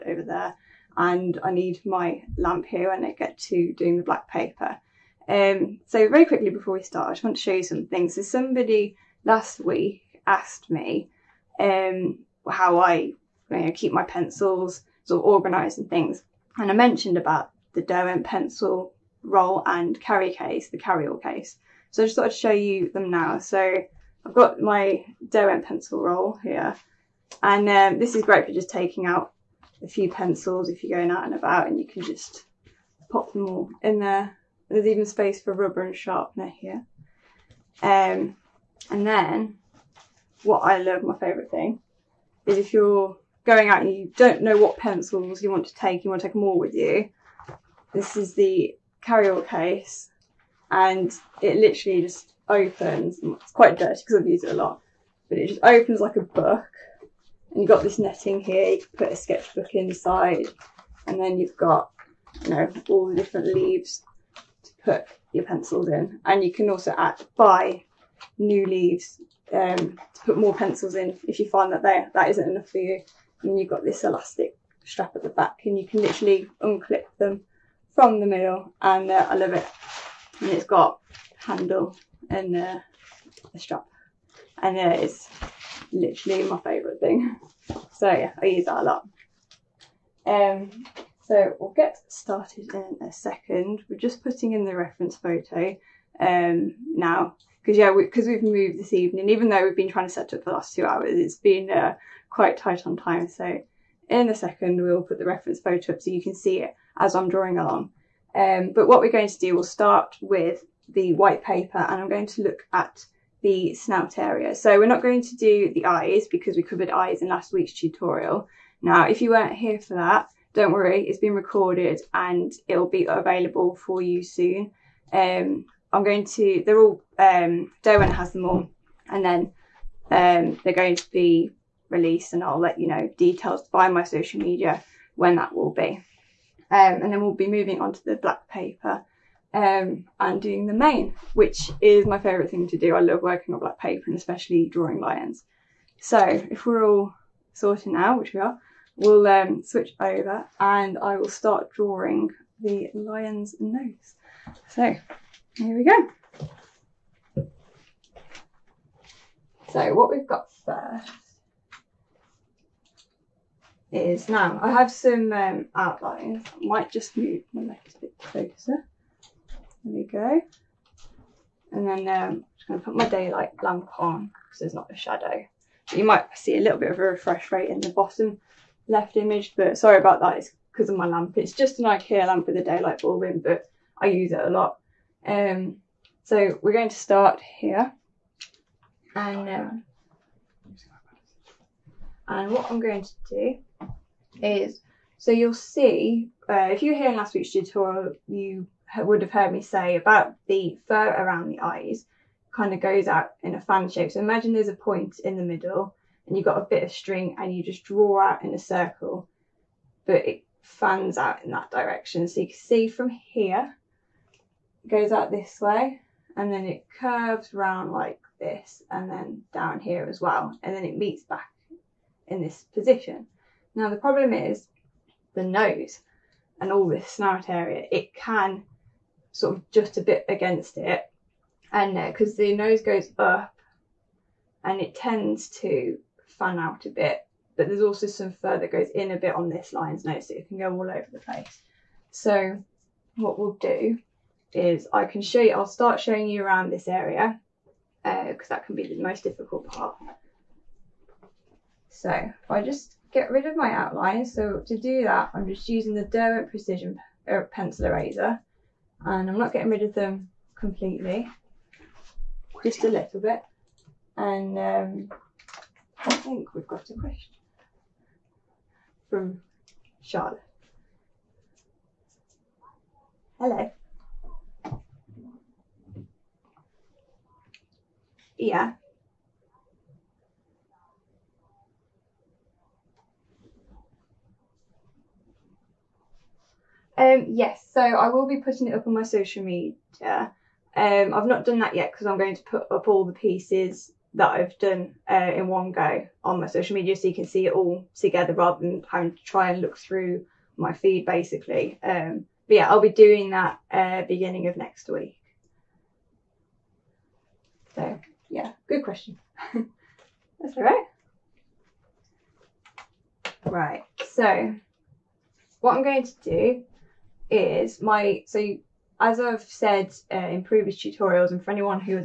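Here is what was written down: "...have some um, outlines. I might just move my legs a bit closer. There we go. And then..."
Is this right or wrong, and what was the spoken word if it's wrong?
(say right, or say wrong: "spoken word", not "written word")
right.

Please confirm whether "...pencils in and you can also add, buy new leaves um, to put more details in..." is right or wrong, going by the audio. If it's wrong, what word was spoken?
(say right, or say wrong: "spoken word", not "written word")
wrong: "pencils", not "details".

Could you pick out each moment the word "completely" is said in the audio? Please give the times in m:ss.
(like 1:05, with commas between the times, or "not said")
4:20.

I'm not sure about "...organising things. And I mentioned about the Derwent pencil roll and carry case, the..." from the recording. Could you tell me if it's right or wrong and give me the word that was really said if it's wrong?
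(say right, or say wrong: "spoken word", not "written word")
right.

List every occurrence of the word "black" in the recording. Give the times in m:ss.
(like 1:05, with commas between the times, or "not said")
0:04, 2:18, 2:23.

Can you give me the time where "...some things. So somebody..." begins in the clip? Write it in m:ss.
0:07.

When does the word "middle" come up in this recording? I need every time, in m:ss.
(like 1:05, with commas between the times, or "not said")
1:18, 3:25.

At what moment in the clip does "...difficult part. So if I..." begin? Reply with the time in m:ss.
4:09.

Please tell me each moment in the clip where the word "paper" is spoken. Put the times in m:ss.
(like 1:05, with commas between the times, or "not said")
0:04, 1:51, 2:18, 2:23.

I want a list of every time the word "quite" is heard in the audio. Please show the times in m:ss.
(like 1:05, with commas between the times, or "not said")
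0:53, 1:42.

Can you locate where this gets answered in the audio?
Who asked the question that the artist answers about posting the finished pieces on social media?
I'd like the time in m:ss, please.
4:30.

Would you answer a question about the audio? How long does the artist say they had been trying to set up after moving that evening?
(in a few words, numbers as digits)
2 hours.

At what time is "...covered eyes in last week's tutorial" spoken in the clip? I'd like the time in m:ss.
1:56.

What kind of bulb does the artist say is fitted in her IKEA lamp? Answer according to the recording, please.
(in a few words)
Daylight bulb.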